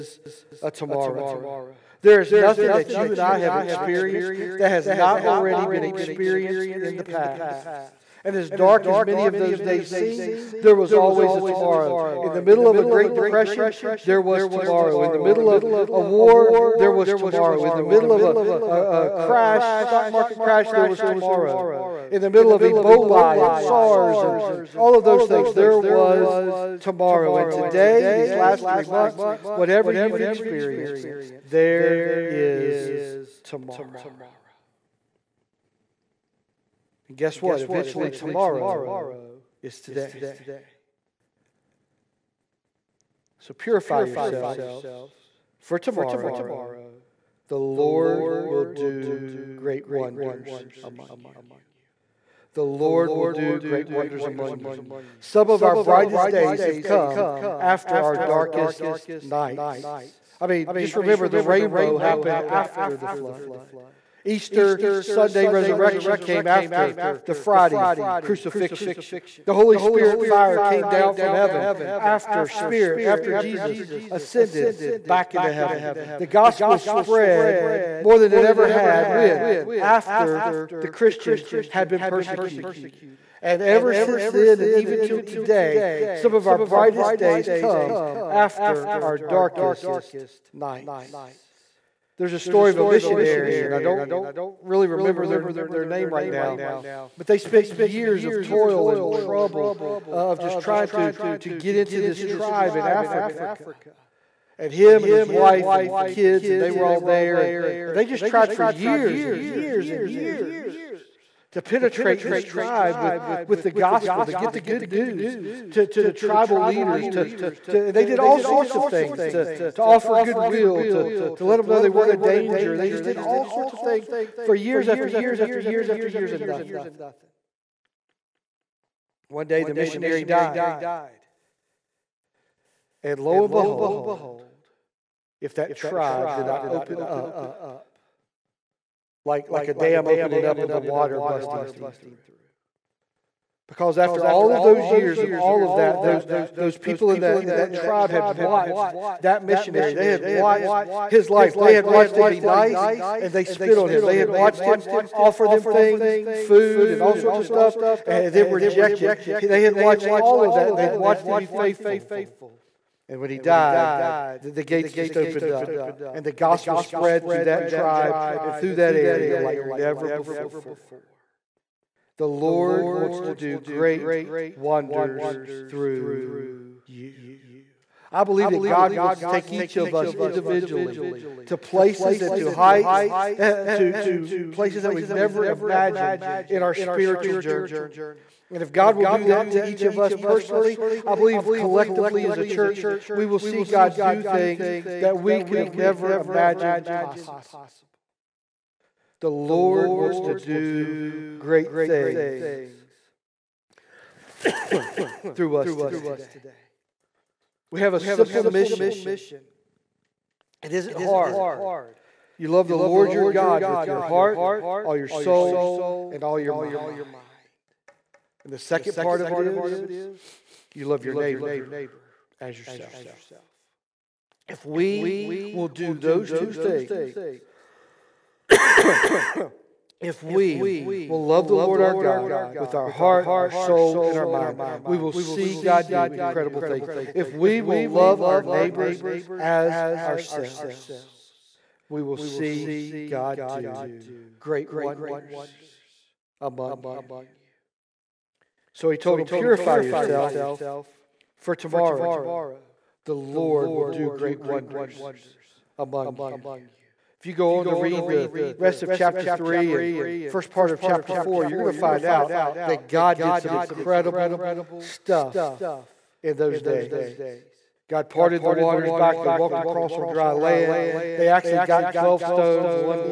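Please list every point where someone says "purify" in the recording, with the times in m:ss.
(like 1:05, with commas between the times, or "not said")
0:43, 4:09.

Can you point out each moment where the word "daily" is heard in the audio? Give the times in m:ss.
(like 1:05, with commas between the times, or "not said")
not said.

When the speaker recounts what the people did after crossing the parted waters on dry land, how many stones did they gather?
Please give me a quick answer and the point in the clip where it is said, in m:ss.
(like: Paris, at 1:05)
12, at 4:31.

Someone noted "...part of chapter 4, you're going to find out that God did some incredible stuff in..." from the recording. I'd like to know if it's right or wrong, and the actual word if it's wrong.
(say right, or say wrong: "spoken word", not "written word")
right.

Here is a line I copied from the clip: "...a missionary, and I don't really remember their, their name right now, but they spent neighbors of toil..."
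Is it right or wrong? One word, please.
wrong.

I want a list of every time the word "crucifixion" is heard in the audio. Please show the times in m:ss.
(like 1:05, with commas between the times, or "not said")
1:08.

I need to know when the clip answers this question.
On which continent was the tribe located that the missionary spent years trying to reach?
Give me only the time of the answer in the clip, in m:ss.
1:42.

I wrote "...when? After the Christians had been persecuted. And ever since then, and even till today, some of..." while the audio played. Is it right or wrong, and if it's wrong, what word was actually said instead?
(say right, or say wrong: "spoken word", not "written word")
right.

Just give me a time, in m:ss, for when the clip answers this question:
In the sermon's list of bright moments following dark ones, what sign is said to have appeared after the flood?
1:01.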